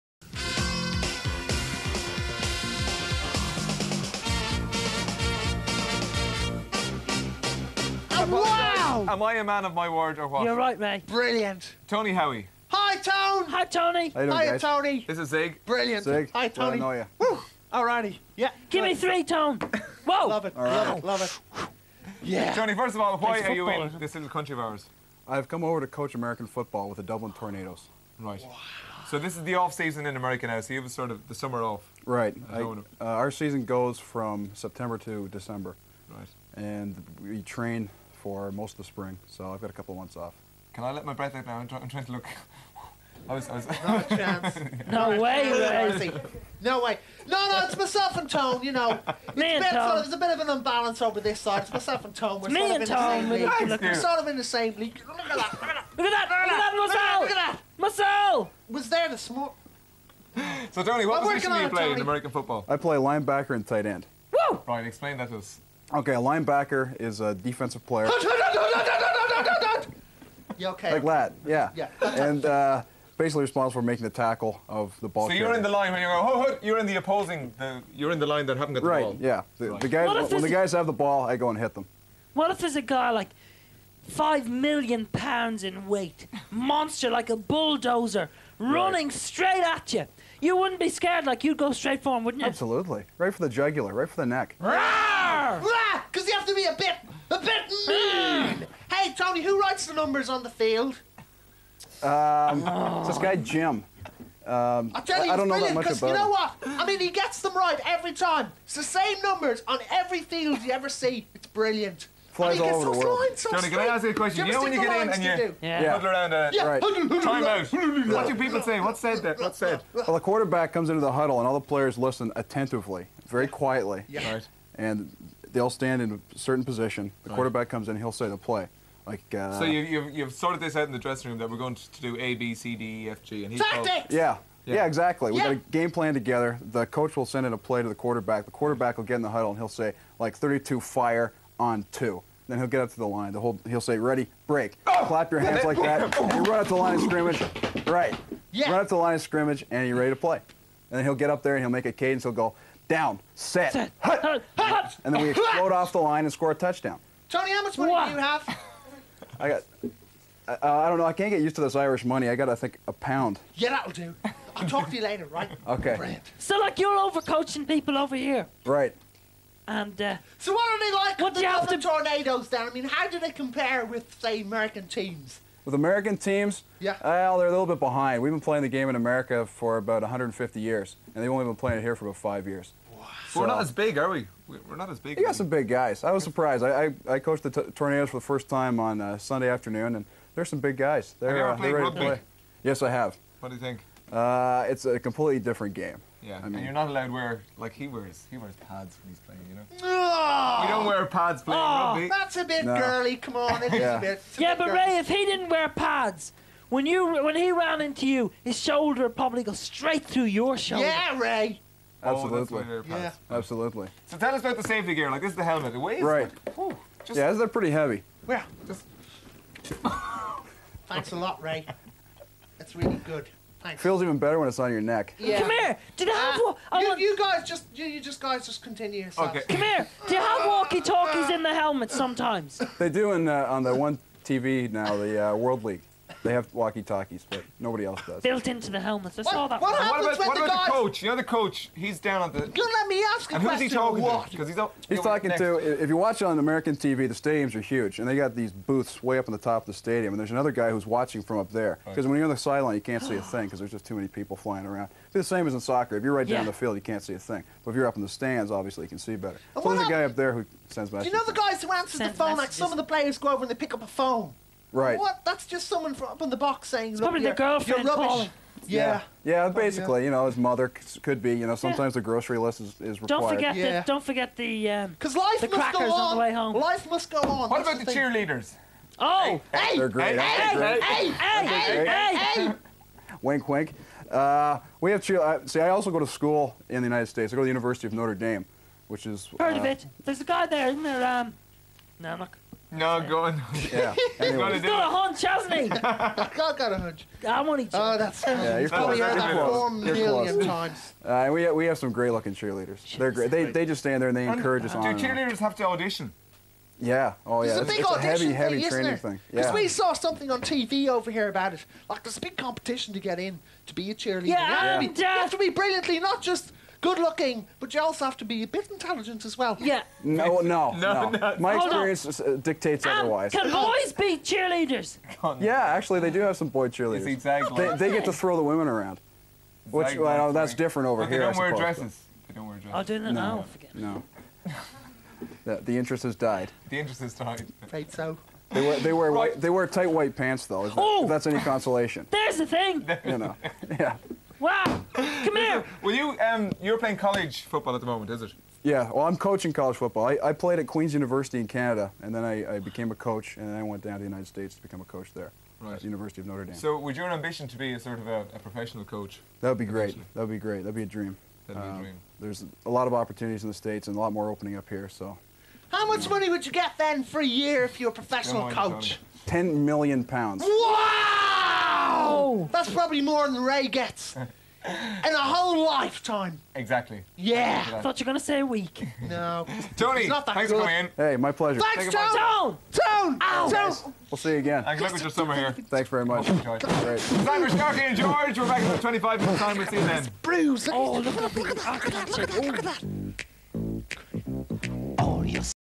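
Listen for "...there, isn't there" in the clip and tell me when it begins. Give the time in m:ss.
4:50.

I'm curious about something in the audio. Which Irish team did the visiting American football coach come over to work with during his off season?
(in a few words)
Dublin Tornadoes.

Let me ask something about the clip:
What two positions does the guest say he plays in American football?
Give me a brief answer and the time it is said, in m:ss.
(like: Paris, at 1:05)
Linebacker and tight end, at 1:02.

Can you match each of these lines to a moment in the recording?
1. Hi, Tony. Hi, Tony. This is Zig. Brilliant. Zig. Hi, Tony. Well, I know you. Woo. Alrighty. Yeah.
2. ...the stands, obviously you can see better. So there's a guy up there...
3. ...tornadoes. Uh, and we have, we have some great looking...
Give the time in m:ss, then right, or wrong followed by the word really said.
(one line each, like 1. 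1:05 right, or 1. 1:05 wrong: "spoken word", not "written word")
1. 0:13 right
2. 4:18 right
3. 5:00 wrong: "times", not "tornadoes".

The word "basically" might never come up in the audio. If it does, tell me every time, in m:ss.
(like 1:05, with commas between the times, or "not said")
1:13, 4:29.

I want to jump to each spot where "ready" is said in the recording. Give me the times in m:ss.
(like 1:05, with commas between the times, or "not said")
2:23, 2:29, 3:11.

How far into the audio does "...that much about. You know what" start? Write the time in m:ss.
1:45.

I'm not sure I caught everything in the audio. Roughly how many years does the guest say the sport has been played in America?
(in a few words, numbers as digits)
150.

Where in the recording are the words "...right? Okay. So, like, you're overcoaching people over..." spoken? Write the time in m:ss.
2:45.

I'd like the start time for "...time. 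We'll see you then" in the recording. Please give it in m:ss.
6:29.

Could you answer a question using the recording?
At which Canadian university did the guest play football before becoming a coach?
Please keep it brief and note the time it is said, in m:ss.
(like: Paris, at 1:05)
Queen's University, at 5:50.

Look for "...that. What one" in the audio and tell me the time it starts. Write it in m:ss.
3:59.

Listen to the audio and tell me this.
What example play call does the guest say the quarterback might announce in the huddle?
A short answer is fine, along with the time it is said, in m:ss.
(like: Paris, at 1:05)
32 fire on two, at 2:20.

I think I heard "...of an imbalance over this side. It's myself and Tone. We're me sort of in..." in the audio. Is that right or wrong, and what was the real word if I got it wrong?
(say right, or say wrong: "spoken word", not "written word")
right.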